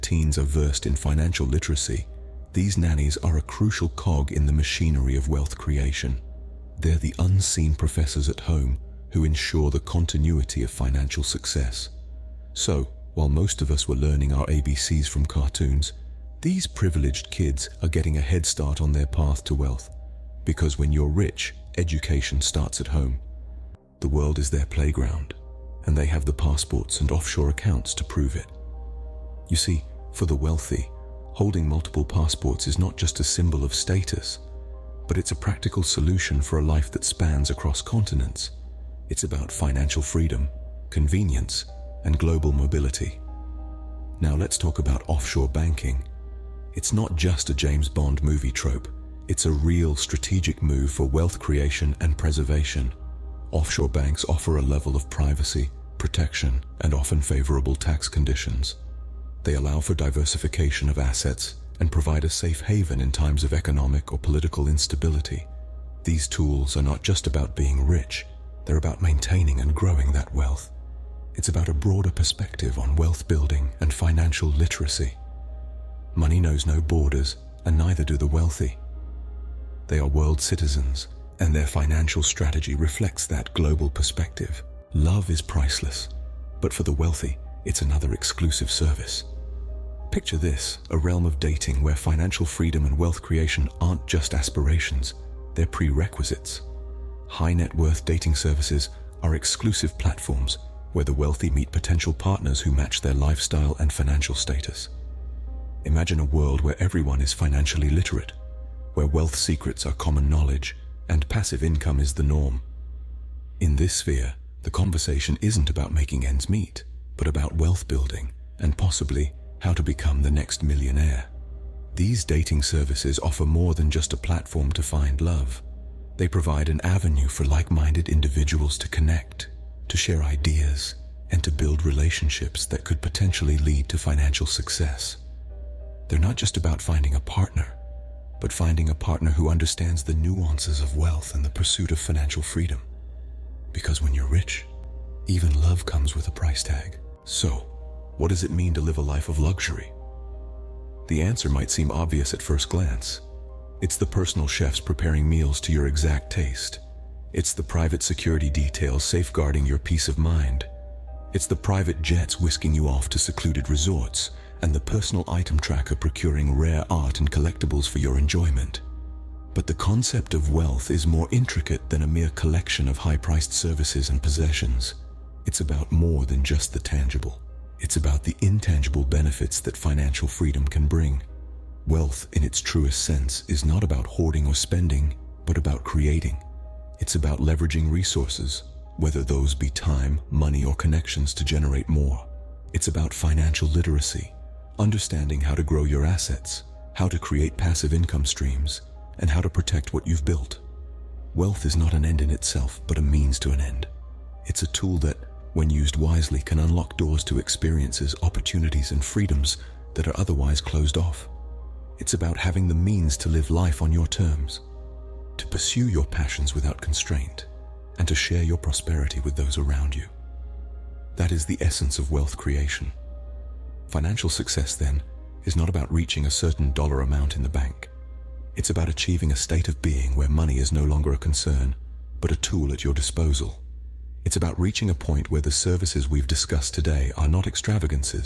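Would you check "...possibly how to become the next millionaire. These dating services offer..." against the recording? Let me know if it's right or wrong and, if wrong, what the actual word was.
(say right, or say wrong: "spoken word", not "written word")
right.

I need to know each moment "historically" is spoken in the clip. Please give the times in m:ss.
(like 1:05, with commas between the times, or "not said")
not said.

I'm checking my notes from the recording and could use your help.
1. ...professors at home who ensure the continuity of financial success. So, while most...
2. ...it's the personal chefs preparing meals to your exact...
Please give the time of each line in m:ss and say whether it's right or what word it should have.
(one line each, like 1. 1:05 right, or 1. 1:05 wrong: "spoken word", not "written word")
1. 0:07 right
2. 2:33 right.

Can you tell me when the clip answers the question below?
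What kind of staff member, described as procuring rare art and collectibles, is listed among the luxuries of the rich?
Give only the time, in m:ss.
2:44.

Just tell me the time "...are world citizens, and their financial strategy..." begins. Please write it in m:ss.
1:19.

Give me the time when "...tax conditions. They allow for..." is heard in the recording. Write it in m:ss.
0:57.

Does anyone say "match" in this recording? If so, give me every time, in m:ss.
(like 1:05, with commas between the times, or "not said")
1:42.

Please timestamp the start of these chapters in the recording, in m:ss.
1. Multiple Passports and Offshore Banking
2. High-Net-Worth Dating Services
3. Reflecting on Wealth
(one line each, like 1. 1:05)
1. 0:22
2. 1:23
3. 2:26.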